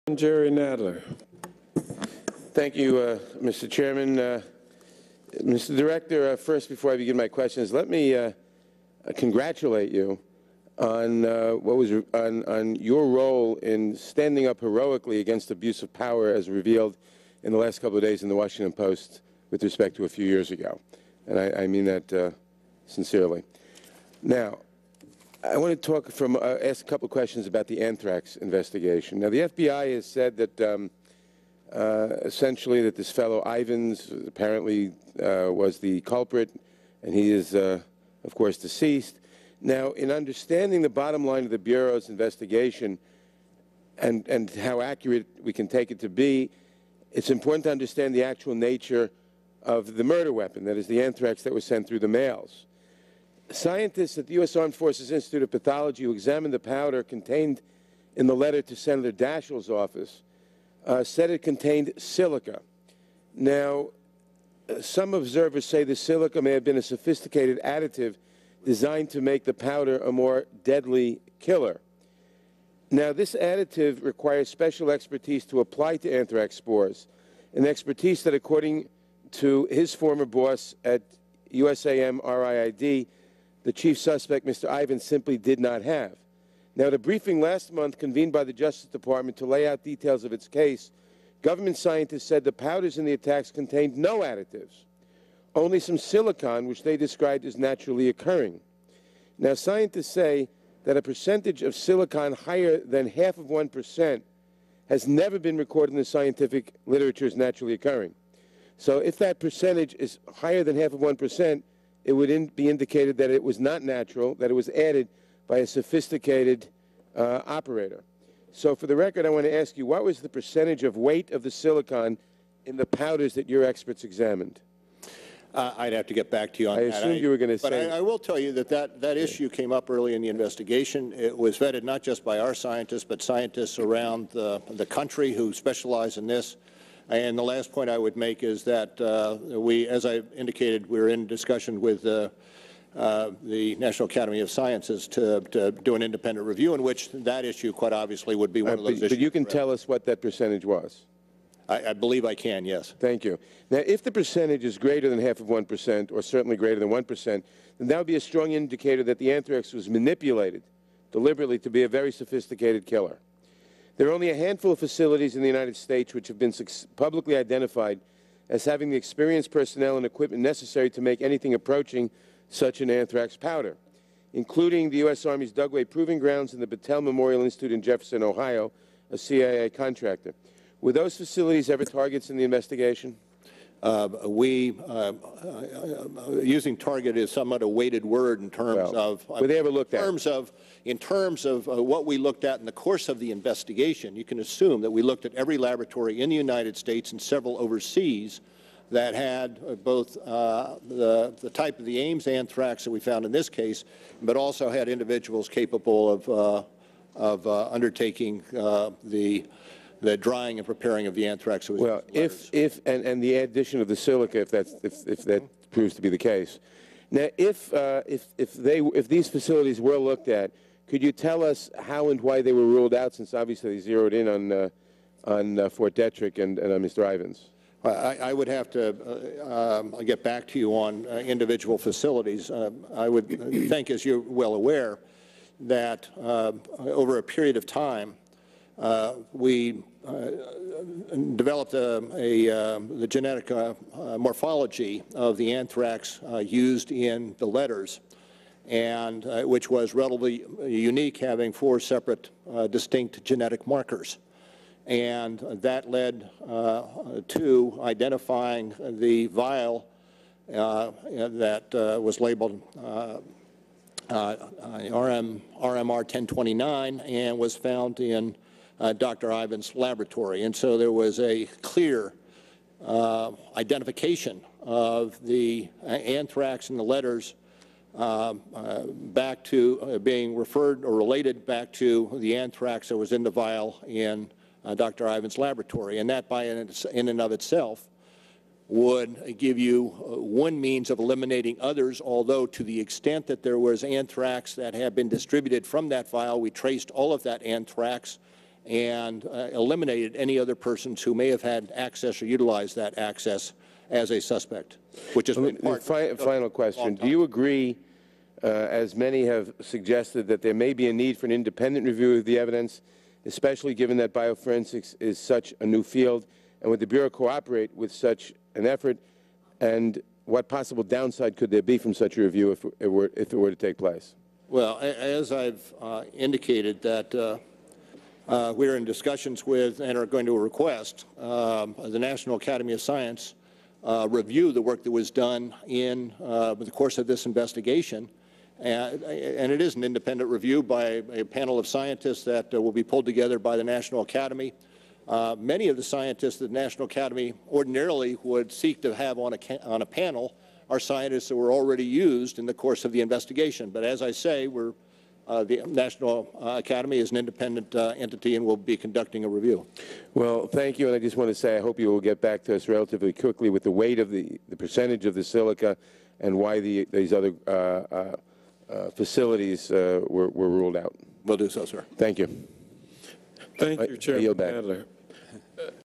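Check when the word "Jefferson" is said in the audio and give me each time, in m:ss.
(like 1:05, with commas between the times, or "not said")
2:57.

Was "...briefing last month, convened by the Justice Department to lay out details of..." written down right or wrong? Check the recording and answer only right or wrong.
right.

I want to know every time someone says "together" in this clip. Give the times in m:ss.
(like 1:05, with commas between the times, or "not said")
5:43.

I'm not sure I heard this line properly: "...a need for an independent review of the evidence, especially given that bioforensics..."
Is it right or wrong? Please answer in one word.
right.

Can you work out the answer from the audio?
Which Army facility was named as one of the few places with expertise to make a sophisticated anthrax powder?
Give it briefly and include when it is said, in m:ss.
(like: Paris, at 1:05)
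Dugway Proving Grounds, at 2:55.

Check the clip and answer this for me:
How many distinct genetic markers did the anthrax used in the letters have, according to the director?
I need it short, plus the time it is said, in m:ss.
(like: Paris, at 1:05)
4, at 4:11.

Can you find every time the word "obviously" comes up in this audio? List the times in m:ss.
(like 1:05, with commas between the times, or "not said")
2:27, 3:43.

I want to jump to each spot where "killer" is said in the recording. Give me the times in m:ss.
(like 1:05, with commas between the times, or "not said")
1:11, 2:42.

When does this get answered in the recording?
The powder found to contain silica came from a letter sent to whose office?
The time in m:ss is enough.
0:58.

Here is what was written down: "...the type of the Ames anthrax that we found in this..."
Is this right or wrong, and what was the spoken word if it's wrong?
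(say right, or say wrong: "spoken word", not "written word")
right.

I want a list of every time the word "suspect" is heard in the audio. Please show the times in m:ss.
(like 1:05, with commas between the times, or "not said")
1:23, 5:04.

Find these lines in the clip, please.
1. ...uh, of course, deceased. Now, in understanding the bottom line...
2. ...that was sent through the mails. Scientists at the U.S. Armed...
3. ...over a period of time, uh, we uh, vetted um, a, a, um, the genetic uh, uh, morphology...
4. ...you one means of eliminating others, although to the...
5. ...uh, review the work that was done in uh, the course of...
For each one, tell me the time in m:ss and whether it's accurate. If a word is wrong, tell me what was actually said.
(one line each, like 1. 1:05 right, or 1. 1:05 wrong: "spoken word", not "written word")
1. 0:37 right
2. 0:51 right
3. 3:56 wrong: "developed", not "vetted"
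4. 4:49 right
5. 5:33 right.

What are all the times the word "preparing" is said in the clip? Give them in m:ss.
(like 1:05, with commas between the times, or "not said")
3:30.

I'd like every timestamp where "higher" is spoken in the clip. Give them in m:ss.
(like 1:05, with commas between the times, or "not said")
1:42, 1:50.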